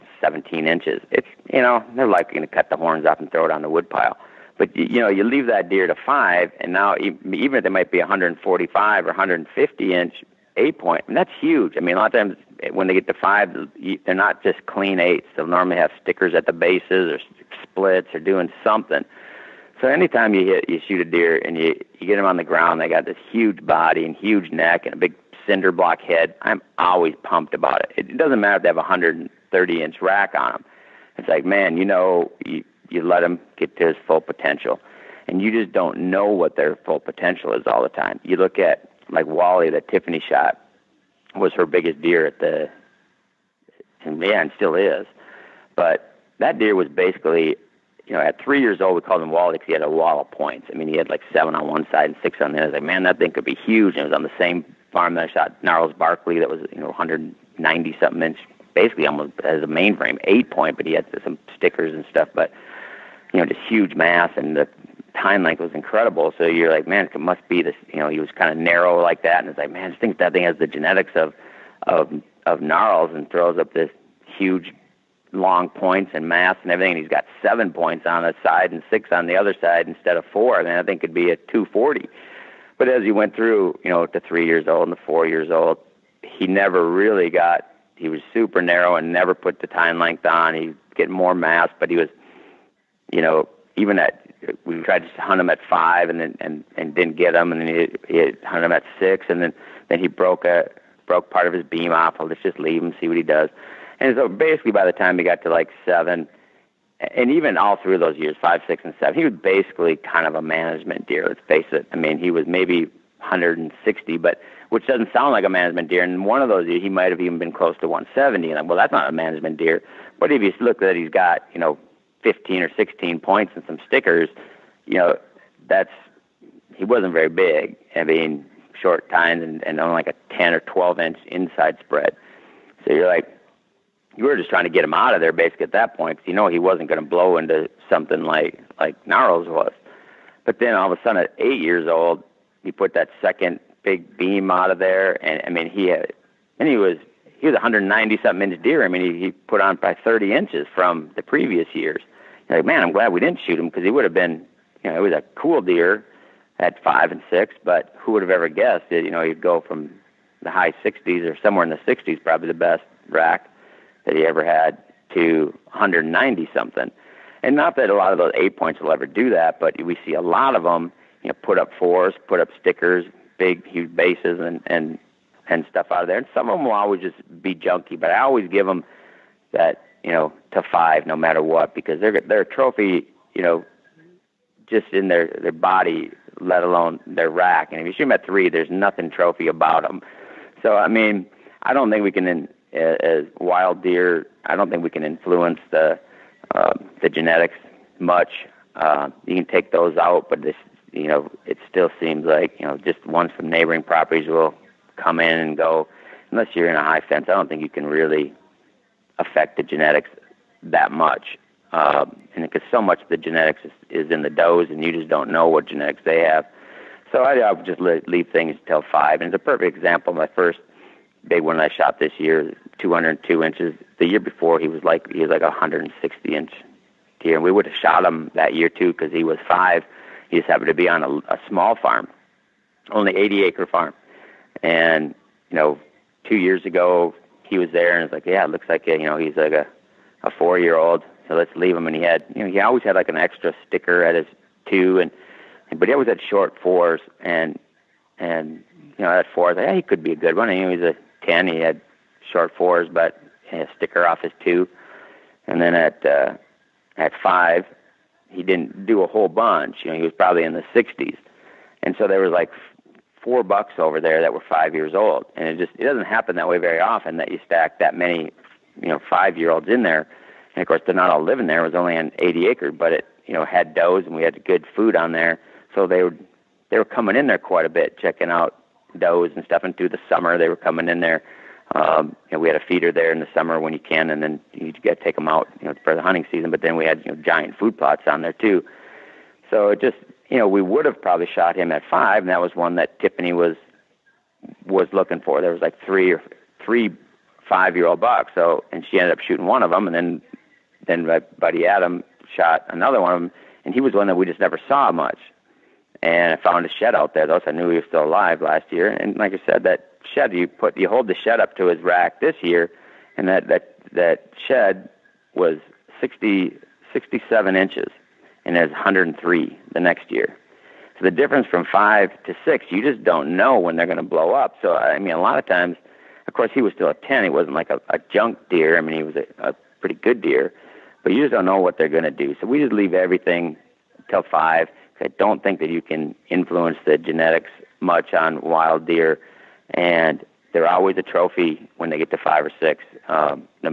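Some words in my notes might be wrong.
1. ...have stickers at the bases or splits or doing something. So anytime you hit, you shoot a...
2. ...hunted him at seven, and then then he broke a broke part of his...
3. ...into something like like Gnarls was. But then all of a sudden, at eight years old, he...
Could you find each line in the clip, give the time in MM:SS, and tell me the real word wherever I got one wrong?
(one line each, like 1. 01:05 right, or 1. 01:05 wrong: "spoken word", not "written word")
1. 00:15 right
2. 01:38 wrong: "six", not "seven"
3. 02:17 right.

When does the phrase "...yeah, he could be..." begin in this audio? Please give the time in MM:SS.
04:09.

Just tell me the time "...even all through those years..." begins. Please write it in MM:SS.
01:47.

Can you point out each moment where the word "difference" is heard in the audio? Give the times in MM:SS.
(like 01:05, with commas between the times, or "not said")
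05:21.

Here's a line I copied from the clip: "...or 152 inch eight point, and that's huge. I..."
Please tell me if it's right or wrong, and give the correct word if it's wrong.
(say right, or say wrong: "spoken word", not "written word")
wrong: "150", not "152".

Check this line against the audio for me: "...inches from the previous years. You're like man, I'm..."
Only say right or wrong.
right.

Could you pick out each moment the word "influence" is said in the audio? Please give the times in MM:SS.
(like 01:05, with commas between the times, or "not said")
03:15, 05:36.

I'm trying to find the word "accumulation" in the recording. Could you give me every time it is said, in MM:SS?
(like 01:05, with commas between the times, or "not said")
not said.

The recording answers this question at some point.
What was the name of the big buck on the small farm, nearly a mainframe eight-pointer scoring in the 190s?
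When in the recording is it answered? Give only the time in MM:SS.
00:55.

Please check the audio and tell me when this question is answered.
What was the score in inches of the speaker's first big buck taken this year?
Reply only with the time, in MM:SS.
03:42.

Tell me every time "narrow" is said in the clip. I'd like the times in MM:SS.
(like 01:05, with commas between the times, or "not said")
01:08, 01:28.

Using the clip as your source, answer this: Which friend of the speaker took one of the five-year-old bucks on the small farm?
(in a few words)
Adam.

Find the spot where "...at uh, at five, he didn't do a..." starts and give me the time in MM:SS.
04:15.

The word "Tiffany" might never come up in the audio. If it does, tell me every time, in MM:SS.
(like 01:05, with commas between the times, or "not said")
00:39, 04:52.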